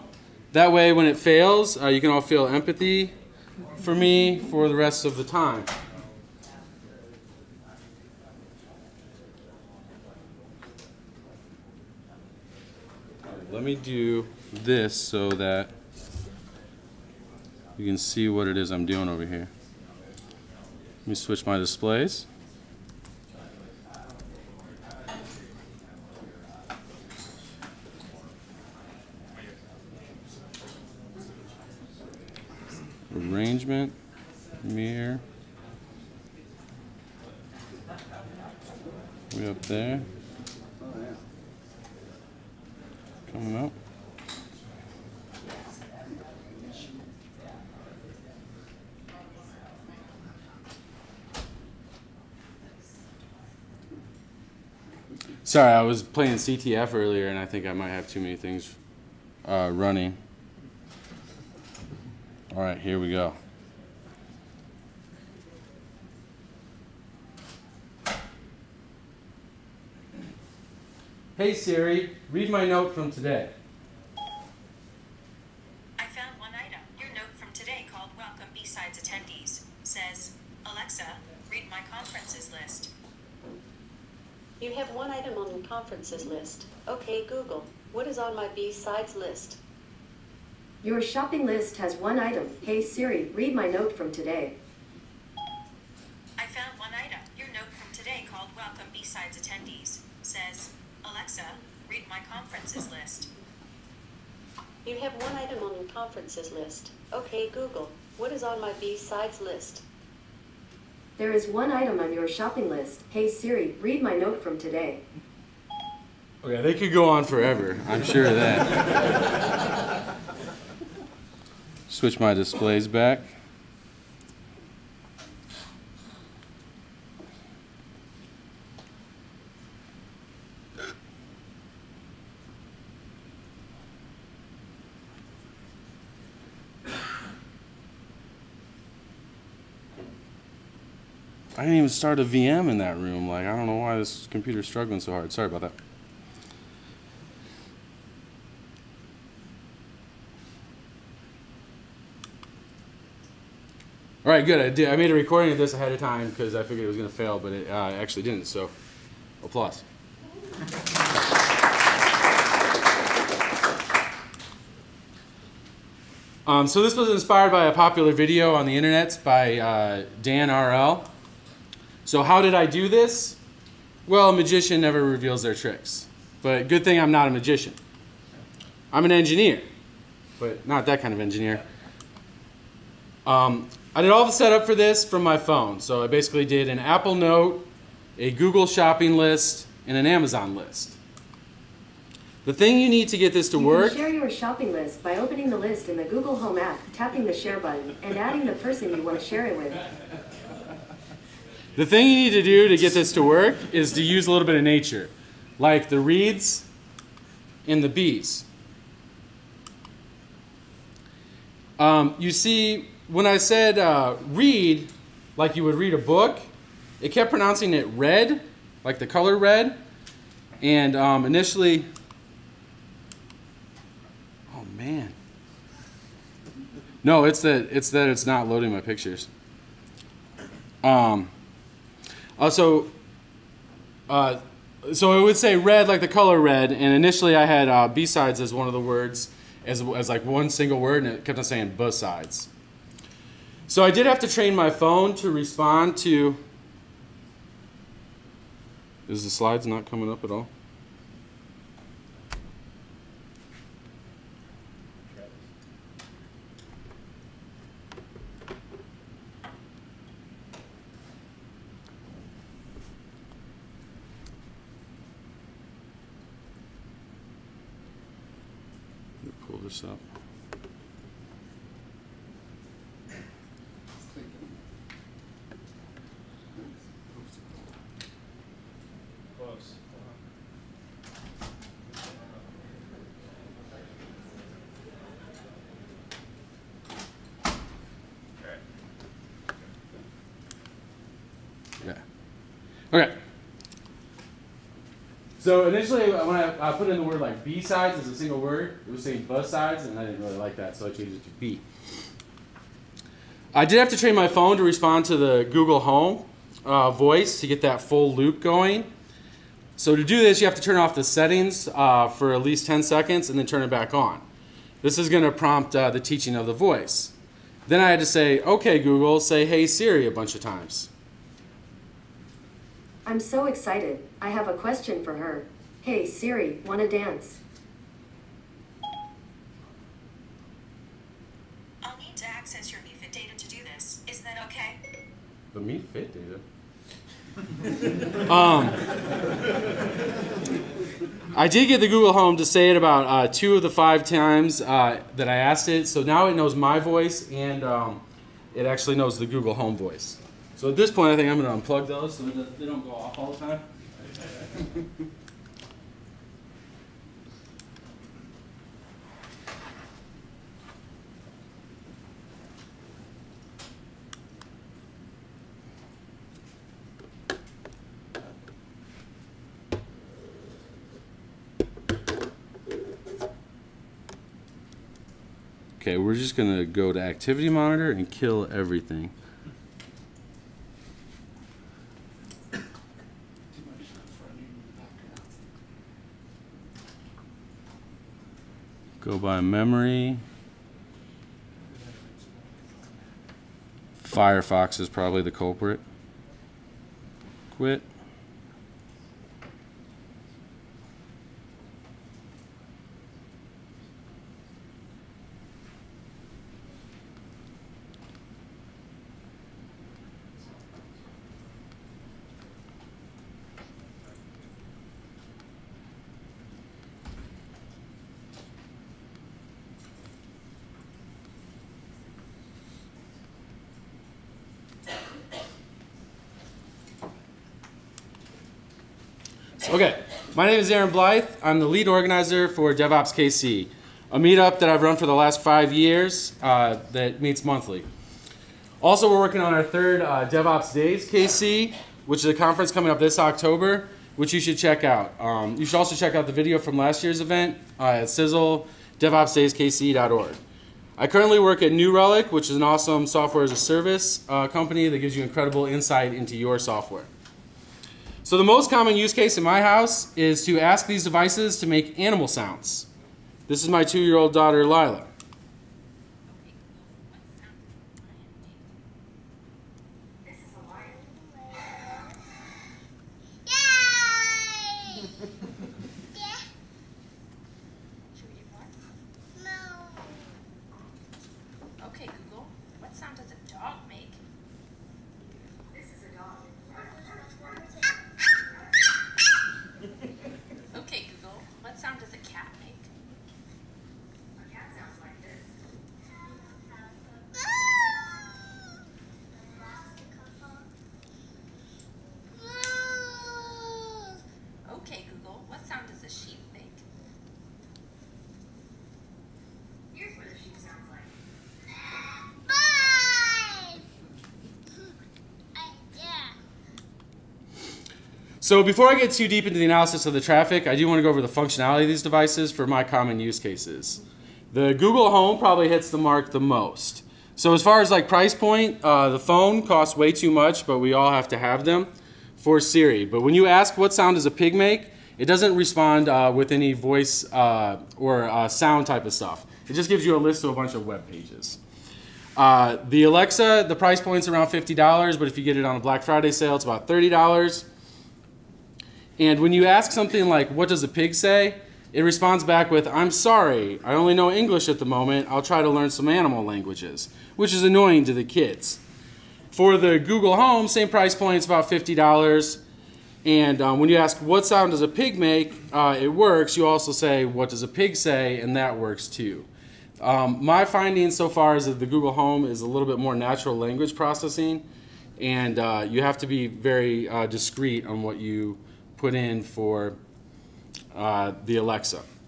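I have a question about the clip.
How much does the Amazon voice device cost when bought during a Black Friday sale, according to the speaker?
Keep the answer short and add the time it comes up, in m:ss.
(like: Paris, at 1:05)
$30, at 9:06.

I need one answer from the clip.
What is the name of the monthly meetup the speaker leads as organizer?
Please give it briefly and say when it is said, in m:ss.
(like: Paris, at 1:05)
DevOps KC, at 7:12.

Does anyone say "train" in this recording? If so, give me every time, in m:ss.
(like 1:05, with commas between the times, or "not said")
4:04, 5:03.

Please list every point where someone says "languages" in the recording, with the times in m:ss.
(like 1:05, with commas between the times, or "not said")
9:16, 9:33.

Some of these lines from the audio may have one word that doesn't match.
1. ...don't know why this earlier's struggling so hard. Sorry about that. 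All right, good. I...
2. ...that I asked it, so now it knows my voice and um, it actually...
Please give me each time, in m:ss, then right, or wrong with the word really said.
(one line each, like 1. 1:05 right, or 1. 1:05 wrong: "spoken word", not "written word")
1. 2:23 wrong: "computer", not "earlier"
2. 5:45 right.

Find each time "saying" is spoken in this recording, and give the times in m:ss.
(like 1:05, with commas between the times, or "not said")
4:01, 4:59.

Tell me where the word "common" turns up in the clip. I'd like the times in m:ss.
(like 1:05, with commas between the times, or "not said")
7:38, 8:42.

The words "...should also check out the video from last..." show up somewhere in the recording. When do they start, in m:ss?
7:25.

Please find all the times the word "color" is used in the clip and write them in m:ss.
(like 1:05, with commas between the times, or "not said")
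3:39, 3:56.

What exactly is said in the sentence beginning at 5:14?
This is going to prompt uh, the teaching of the voice.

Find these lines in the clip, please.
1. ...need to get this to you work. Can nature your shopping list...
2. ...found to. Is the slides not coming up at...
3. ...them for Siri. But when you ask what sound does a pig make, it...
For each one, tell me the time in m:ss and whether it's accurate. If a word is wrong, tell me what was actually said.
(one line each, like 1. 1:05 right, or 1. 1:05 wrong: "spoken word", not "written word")
1. 3:12 wrong: "share", not "nature"
2. 4:05 wrong: "respond", not "found"
3. 8:51 right.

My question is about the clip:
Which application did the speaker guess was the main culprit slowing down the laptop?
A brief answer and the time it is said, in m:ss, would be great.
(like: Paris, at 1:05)
Firefox, at 6:34.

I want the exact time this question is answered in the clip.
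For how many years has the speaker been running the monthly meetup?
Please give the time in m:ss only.
7:15.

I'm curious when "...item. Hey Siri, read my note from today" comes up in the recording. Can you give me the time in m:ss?
1:32.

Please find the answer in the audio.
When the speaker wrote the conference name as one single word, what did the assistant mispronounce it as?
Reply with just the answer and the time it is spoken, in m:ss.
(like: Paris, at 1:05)
bus sides, at 4:59.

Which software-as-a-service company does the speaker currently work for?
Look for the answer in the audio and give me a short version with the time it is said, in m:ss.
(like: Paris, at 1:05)
New Relic, at 7:31.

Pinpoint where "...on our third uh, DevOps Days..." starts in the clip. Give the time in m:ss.
7:19.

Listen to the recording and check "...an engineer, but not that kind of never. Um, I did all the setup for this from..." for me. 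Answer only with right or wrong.
wrong.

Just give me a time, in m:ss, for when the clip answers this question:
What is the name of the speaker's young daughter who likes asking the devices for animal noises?
7:44.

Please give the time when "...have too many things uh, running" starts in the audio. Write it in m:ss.
0:57.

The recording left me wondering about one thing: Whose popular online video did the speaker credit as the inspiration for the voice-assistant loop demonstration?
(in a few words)
Dan RL.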